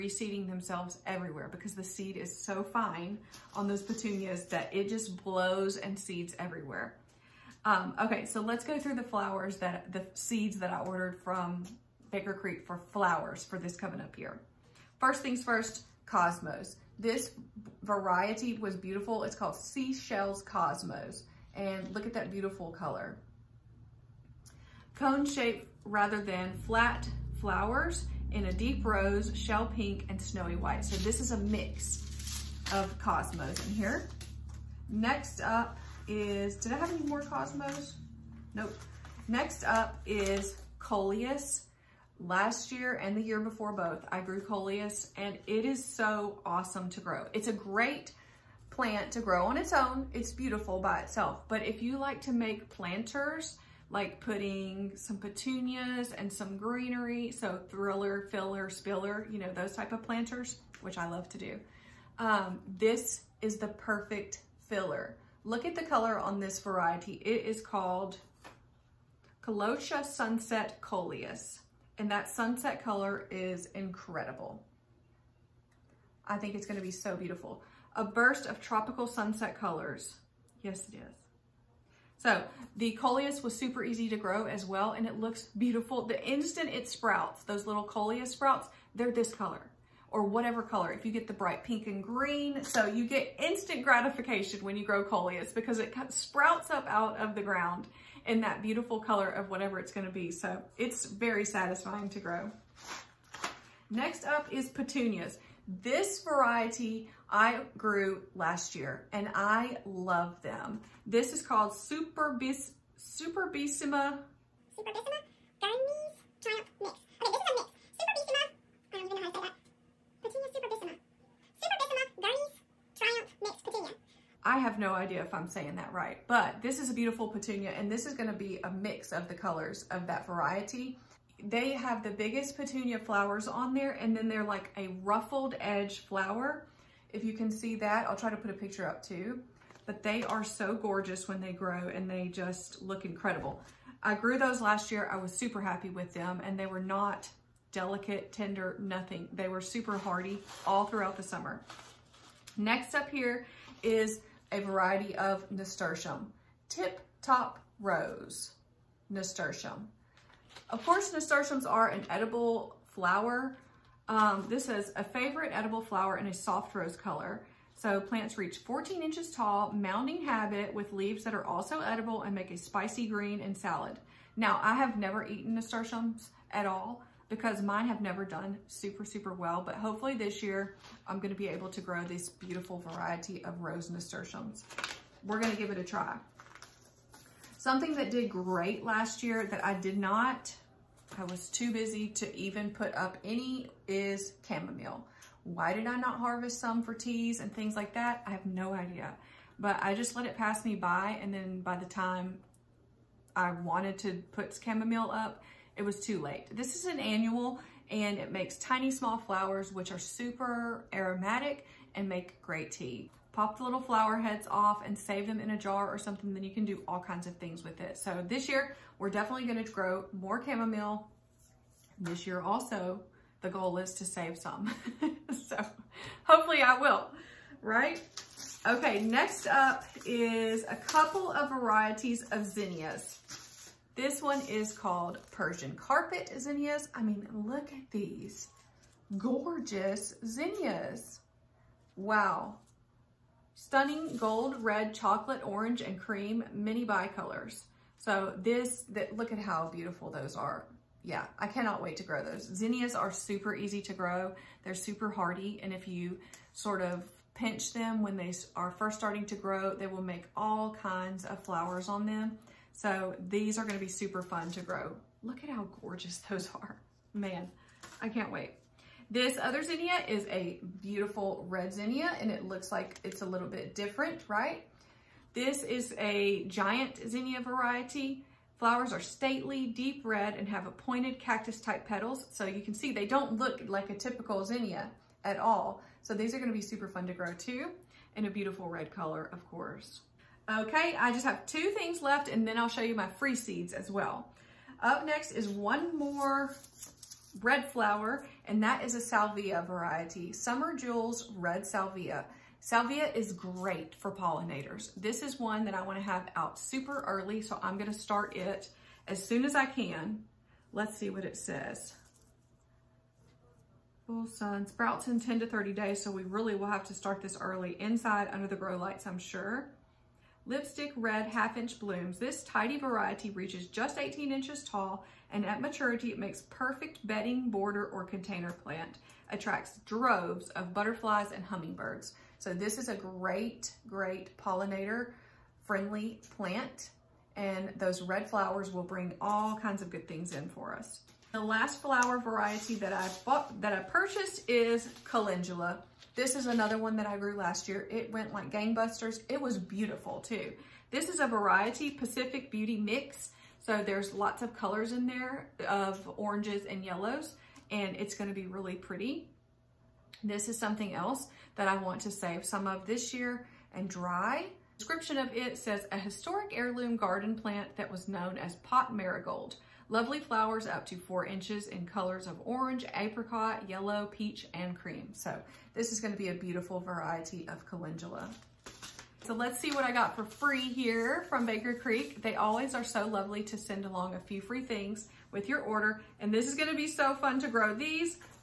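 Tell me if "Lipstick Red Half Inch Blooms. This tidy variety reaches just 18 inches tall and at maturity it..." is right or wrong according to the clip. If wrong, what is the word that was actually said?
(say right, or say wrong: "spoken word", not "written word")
right.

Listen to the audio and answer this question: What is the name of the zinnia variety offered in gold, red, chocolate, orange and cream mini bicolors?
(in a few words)
Persian Carpet.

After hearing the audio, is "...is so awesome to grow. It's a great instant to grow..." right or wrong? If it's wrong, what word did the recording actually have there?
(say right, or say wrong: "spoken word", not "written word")
wrong: "plant", not "instant".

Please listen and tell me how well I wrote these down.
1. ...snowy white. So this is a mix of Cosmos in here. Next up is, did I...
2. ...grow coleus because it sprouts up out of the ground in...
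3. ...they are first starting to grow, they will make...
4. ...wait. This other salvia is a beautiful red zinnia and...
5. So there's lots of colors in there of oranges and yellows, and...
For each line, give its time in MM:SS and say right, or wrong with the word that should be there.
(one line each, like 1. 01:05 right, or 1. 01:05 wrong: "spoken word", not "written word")
1. 00:30 right
2. 01:34 right
3. 04:18 right
4. 04:28 wrong: "zinnia", not "salvia"
5. 05:53 right.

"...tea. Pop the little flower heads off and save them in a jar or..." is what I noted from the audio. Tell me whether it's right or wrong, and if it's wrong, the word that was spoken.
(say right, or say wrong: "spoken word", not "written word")
right.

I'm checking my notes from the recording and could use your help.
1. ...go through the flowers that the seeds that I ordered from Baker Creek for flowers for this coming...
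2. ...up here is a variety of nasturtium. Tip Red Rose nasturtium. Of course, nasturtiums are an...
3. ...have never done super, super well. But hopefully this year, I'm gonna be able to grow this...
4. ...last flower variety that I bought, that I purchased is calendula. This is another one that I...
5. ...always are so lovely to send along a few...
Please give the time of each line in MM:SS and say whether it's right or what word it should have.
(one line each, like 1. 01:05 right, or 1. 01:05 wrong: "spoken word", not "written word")
1. 00:08 right
2. 02:32 wrong: "Top", not "Red"
3. 02:57 right
4. 05:41 right
5. 06:22 right.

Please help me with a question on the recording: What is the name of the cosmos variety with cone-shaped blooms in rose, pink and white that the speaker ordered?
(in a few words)
Seashells.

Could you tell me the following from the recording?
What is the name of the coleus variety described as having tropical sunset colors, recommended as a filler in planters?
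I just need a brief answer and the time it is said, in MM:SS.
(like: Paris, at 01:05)
Calotia Sunset, at 01:09.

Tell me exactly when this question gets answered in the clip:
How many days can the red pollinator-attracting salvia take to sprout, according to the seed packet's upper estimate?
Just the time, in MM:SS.
05:15.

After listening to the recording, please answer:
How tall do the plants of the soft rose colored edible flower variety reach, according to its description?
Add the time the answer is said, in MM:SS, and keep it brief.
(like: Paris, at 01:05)
14 inches, at 02:48.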